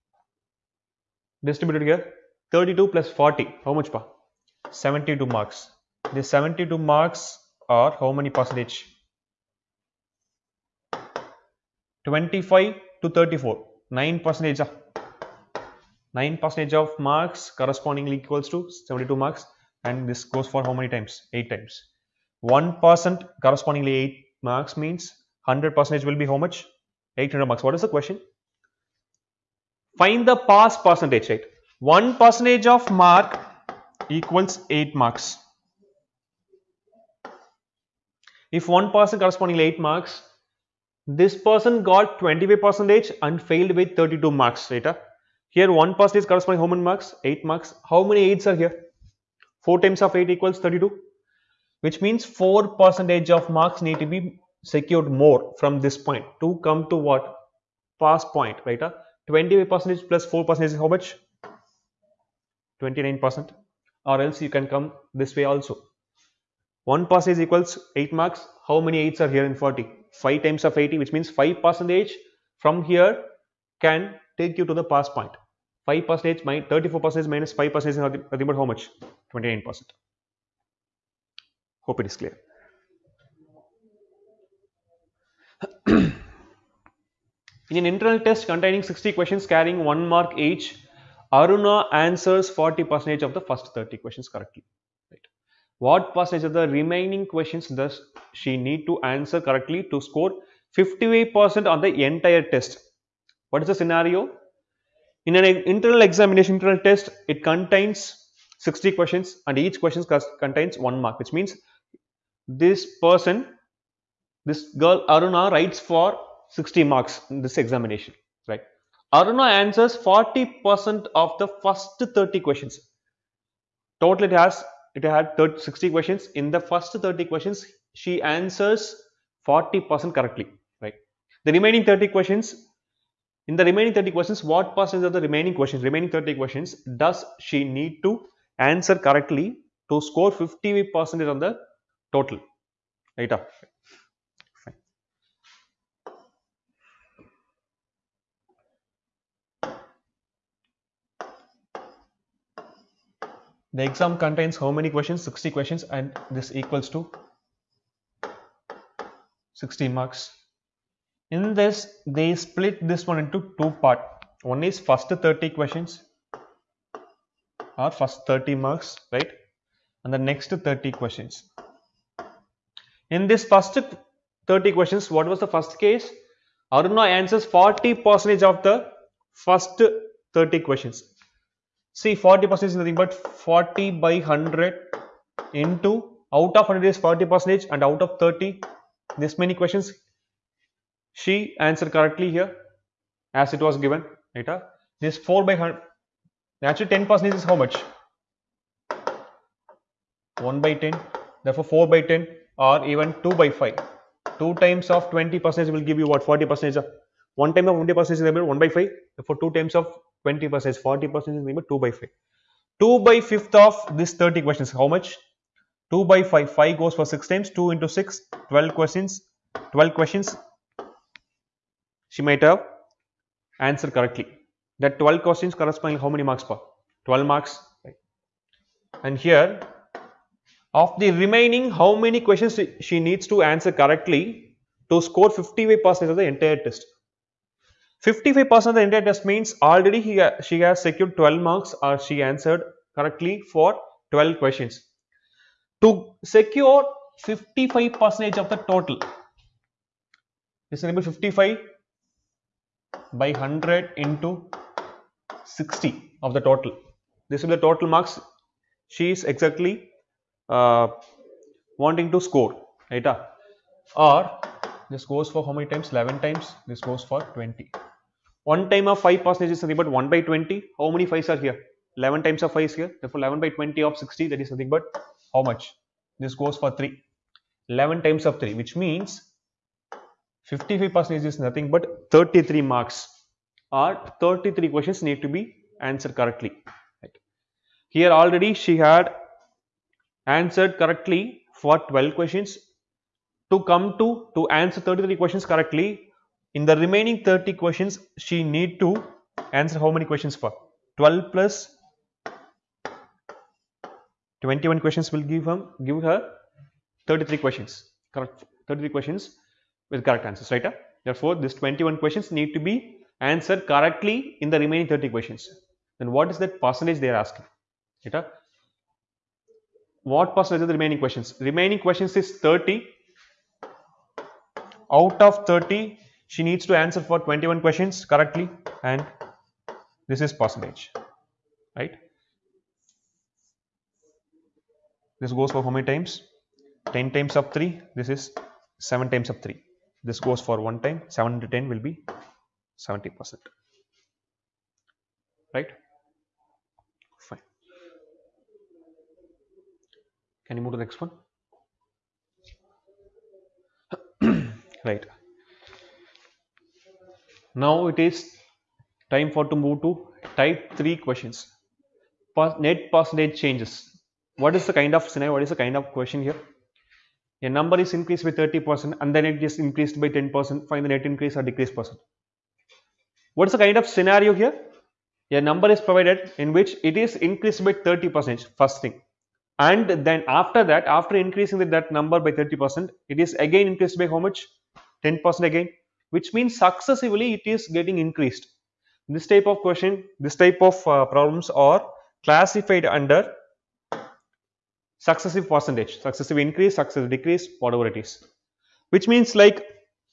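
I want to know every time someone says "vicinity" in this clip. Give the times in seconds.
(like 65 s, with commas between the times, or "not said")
not said.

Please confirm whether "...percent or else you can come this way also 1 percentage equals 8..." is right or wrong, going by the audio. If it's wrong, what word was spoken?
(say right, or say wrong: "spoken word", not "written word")
right.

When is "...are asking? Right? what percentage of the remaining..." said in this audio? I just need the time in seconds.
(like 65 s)
317 s.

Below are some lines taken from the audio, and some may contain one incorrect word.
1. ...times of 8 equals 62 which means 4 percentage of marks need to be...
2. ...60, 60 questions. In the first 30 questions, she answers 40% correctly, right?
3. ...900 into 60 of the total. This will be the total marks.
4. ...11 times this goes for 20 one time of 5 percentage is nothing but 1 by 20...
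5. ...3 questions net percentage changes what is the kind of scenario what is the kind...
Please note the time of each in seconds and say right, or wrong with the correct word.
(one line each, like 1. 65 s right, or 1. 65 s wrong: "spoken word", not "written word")
1. 49 s wrong: "32", not "62"
2. 125 s wrong: "30", not "60"
3. 253 s wrong: "100", not "900"
4. 265 s right
5. 360 s right.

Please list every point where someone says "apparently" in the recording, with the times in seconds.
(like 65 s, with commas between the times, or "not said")
not said.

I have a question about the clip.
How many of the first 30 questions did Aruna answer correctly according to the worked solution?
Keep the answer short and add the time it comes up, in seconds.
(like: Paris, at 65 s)
12, at 218 s.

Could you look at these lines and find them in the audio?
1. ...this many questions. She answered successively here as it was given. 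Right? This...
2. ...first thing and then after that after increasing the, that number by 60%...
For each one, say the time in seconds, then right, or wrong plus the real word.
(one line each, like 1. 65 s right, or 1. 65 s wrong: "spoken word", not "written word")
1. 189 s wrong: "correctly", not "successively"
2. 378 s wrong: "30", not "60".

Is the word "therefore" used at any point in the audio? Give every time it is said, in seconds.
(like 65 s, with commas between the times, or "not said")
201 s, 273 s, 311 s.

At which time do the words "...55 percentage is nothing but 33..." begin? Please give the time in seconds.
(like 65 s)
280 s.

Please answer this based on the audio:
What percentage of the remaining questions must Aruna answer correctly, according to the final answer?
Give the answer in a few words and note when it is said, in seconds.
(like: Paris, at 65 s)
70%, at 342 s.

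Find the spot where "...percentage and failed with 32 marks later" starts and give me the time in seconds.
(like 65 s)
42 s.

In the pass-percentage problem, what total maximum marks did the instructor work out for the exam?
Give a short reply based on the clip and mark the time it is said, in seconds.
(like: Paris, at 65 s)
800 marks, at 27 s.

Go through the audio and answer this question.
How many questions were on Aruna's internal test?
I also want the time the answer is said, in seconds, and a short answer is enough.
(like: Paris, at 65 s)
60, at 88 s.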